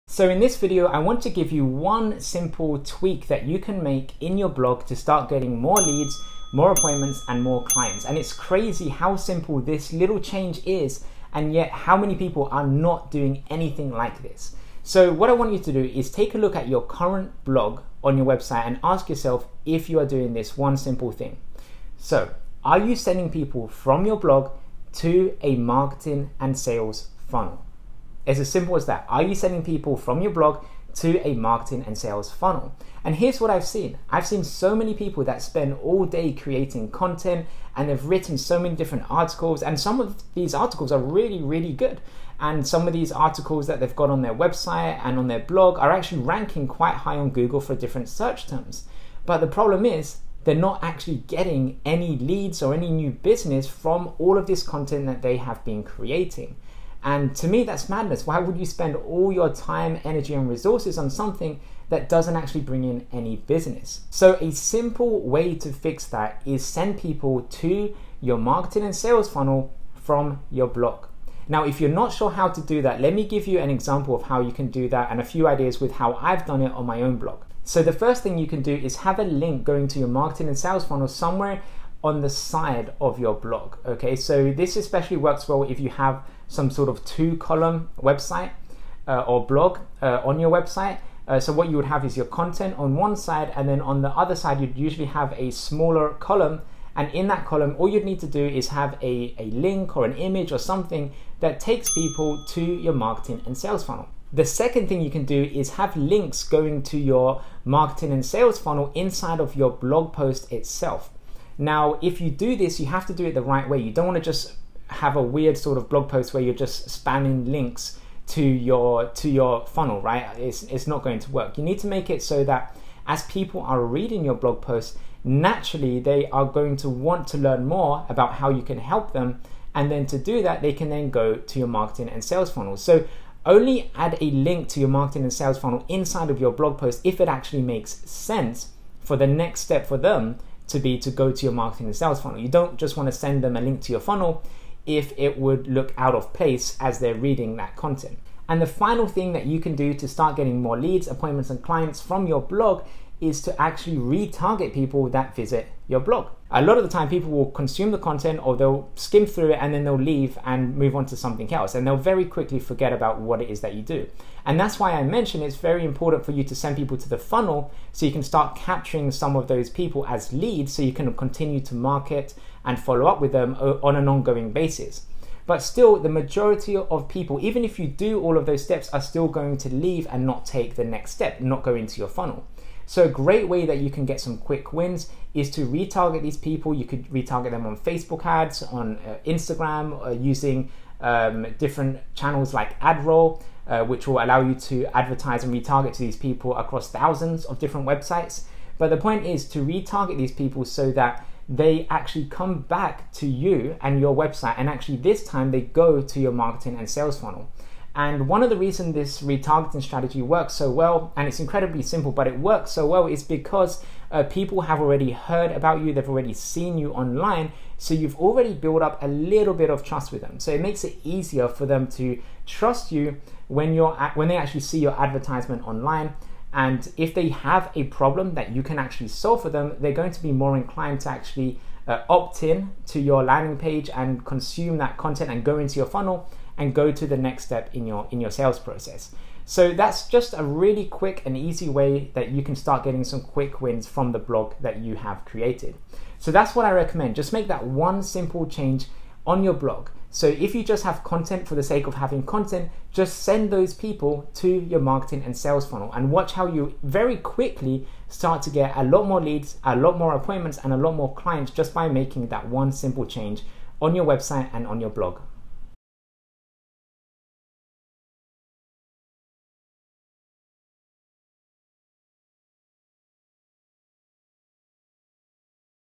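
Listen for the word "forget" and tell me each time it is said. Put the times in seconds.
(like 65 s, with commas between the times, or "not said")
162 s.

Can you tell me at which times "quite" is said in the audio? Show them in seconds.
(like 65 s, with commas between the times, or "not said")
46 s.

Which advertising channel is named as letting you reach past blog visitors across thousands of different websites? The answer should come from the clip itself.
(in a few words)
AdRoll.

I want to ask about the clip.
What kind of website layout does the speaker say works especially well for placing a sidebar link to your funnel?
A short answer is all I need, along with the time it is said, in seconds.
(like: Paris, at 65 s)
Two column, at 87 s.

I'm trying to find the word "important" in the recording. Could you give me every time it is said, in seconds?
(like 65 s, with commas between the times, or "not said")
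165 s.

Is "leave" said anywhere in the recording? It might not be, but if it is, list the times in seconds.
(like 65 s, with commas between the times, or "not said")
159 s, 179 s.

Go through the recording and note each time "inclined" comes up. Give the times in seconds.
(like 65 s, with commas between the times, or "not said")
230 s.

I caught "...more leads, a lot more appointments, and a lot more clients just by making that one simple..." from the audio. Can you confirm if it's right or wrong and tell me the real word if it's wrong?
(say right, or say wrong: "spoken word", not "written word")
right.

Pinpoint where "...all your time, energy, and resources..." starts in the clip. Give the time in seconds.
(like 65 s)
58 s.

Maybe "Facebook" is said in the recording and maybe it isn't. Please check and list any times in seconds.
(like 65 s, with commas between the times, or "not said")
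187 s.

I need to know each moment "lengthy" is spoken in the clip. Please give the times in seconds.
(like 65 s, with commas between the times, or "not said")
not said.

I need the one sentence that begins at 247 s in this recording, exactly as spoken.
Just make that one simple change on your blog.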